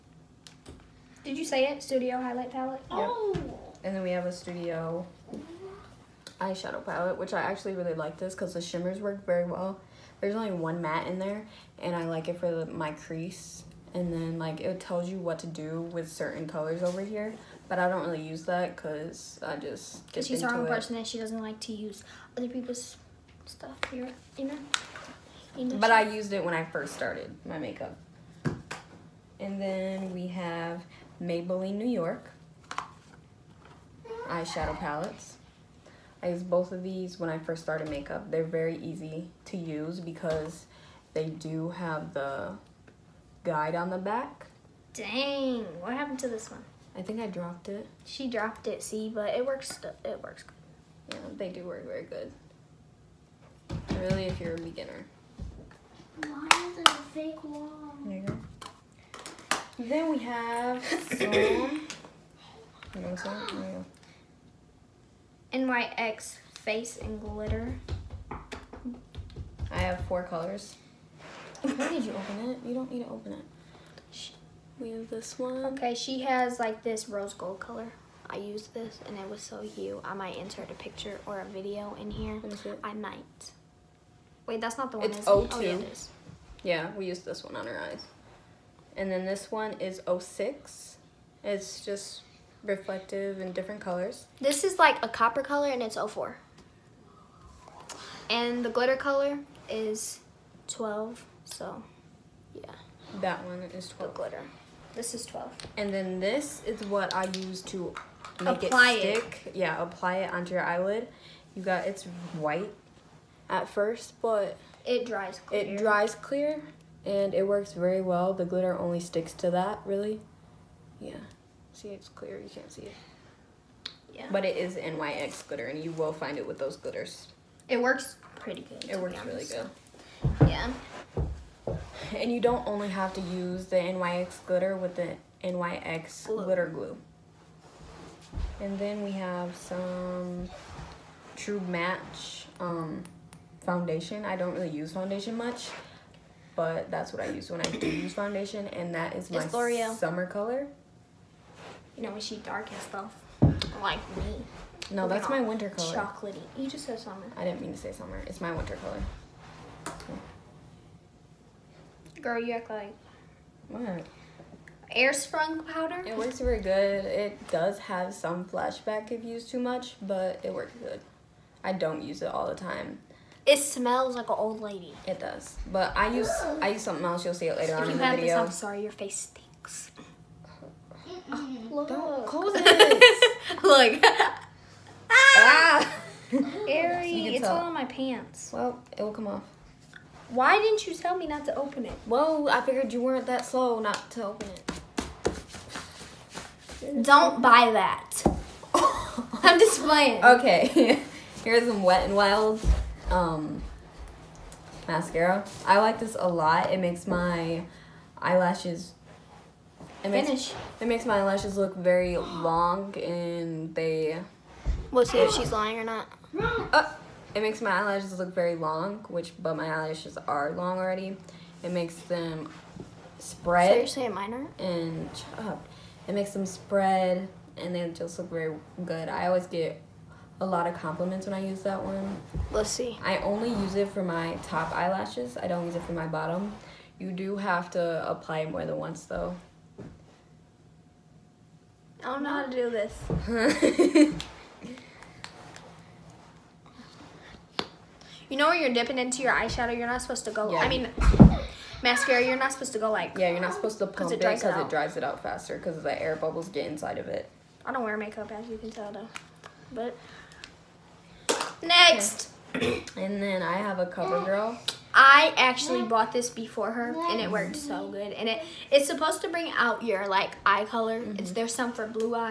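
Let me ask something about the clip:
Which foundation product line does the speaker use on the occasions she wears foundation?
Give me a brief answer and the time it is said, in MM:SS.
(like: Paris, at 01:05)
True Match, at 02:21.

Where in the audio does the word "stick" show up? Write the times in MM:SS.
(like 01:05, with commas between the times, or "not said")
01:49, 01:58.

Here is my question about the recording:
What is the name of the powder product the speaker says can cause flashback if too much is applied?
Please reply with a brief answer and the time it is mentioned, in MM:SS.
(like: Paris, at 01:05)
Airspun, at 02:44.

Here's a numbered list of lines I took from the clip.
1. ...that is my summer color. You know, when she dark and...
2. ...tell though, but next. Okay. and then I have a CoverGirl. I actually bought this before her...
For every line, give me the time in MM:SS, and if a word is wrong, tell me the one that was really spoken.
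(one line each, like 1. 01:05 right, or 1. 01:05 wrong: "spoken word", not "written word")
1. 02:28 right
2. 04:18 right.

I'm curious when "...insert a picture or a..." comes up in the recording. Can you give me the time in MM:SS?
01:20.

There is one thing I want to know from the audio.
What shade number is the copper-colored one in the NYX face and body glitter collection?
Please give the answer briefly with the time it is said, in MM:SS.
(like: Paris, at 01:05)
04, at 01:35.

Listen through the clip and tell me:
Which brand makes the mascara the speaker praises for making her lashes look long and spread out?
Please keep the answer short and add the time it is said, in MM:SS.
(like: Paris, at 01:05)
Wet n Wild, at 03:21.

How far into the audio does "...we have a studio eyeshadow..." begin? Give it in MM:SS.
00:04.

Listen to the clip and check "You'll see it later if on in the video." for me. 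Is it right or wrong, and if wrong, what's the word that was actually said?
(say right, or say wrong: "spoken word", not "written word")
right.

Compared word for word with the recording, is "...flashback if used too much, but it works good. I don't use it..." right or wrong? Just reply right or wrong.
right.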